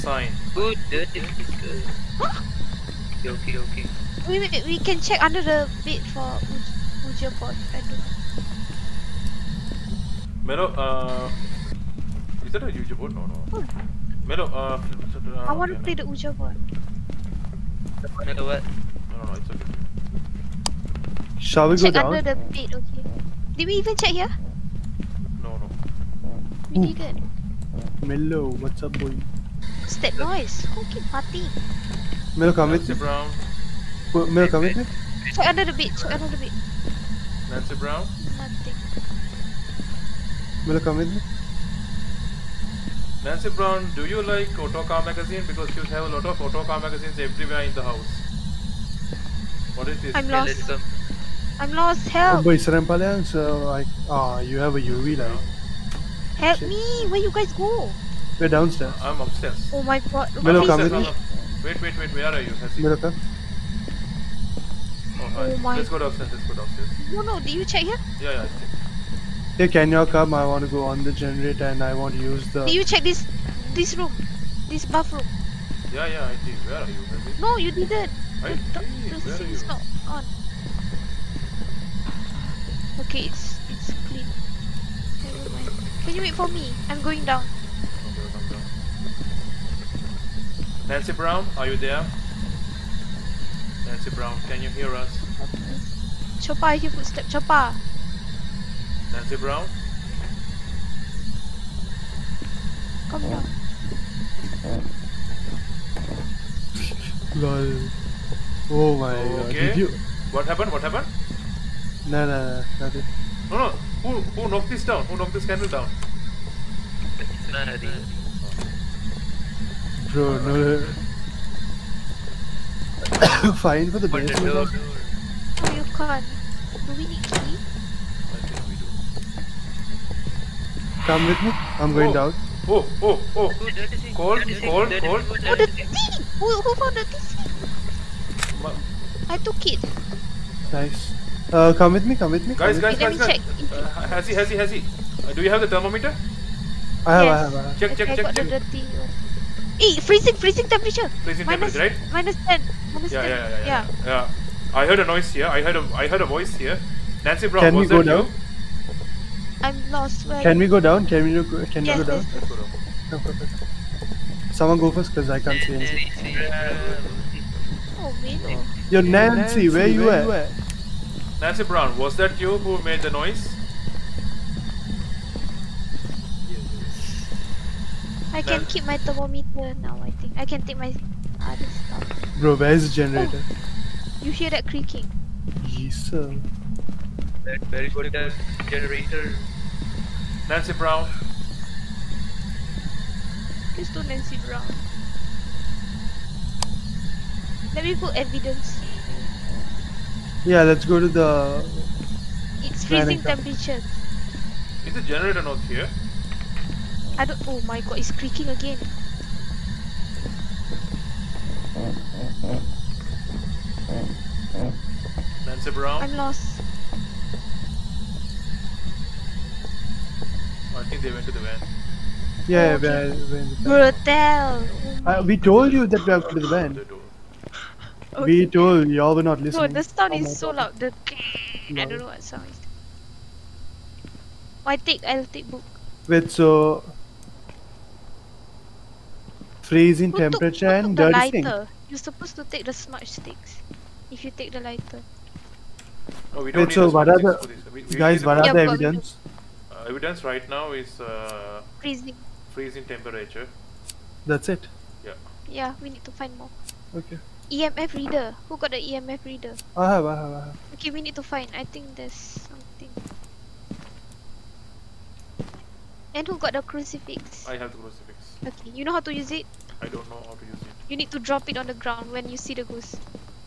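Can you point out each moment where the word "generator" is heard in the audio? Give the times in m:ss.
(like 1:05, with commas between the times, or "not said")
1:11, 3:02, 3:08, 3:25.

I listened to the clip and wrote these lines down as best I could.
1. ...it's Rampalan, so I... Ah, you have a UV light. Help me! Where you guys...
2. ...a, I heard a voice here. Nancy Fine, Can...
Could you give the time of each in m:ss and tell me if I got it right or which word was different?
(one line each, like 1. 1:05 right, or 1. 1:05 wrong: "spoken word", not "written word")
1. 0:52 right
2. 2:35 wrong: "Brown", not "Fine".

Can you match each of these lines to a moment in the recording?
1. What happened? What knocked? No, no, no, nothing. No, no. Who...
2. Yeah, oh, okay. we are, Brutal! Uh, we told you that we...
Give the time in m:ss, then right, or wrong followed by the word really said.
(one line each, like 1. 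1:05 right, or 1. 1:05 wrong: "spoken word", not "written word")
1. 1:50 wrong: "happened", not "knocked"
2. 3:42 right.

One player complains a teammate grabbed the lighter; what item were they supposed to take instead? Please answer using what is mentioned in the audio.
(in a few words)
Smudge sticks.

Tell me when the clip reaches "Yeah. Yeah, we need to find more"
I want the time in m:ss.
4:15.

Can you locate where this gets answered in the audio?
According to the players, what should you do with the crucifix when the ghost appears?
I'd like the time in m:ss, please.
4:31.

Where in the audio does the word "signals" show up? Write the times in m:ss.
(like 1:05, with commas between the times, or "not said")
not said.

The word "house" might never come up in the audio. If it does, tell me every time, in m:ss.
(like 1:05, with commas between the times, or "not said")
0:47.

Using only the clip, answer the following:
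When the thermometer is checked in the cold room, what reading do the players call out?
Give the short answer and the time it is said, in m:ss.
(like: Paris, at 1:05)
-10, at 2:32.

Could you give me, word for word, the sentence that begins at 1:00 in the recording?
Milo, come with Wait, wait, wait.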